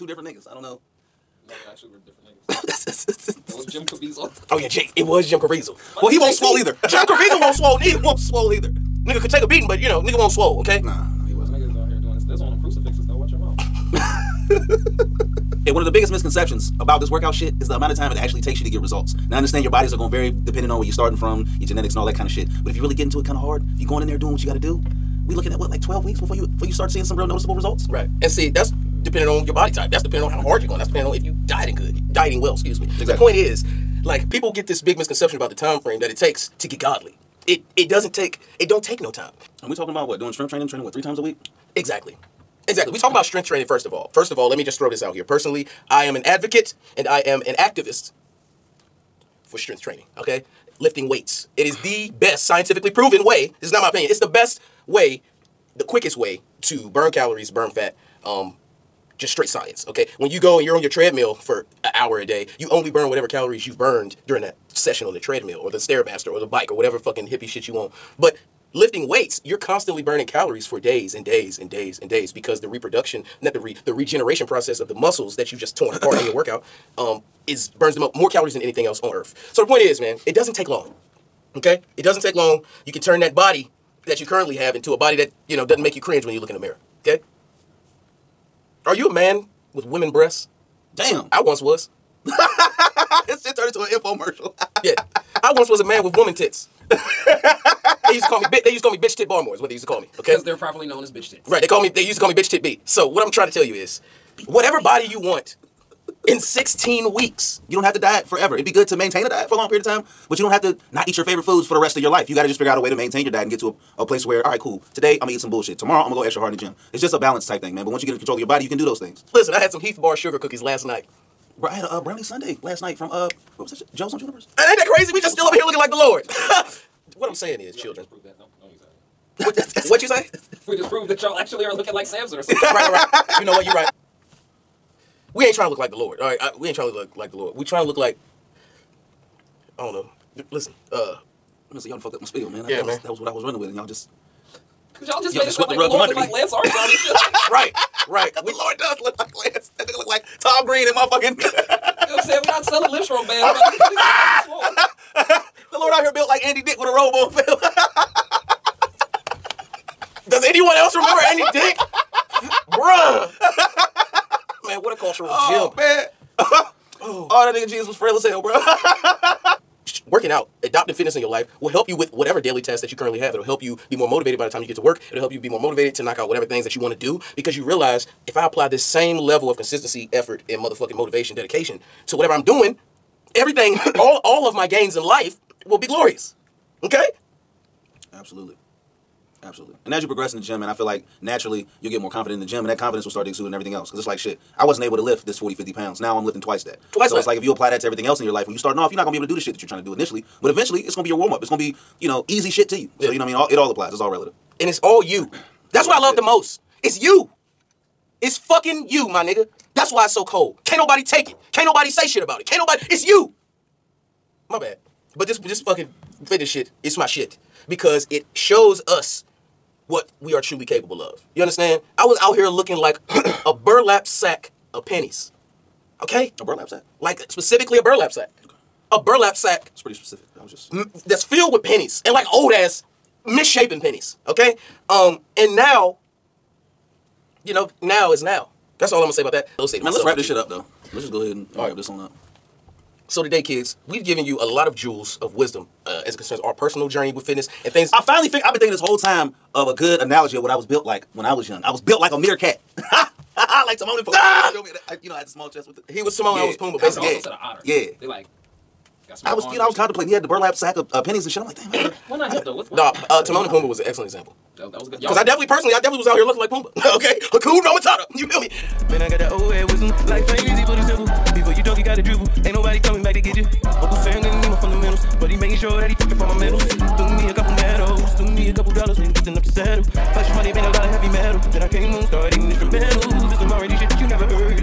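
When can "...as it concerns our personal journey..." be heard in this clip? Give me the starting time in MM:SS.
04:06.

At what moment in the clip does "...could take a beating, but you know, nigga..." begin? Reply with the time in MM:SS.
00:09.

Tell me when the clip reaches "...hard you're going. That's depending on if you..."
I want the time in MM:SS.
00:30.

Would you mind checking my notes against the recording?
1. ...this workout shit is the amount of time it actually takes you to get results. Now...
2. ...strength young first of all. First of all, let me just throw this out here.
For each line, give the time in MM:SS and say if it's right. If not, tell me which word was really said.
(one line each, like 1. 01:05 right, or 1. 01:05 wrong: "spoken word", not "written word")
1. 00:16 right
2. 00:43 wrong: "training", not "young".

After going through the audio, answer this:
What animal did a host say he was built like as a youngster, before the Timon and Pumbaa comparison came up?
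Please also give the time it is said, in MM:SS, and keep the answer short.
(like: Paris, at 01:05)
A meerkat, at 04:12.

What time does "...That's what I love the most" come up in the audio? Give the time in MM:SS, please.
03:25.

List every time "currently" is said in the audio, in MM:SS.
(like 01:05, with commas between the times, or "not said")
01:24, 02:52.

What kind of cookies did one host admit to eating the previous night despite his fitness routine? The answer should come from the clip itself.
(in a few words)
Heath Bar sugar cookies.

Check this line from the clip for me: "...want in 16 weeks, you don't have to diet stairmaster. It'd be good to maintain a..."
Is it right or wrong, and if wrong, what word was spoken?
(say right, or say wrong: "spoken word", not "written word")
wrong: "forever", not "stairmaster".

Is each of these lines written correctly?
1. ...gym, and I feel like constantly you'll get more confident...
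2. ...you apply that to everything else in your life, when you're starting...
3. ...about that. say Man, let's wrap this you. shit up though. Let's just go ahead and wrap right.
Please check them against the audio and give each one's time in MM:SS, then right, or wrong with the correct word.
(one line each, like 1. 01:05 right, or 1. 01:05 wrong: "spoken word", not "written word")
1. 03:10 wrong: "naturally", not "constantly"
2. 03:17 right
3. 03:59 right.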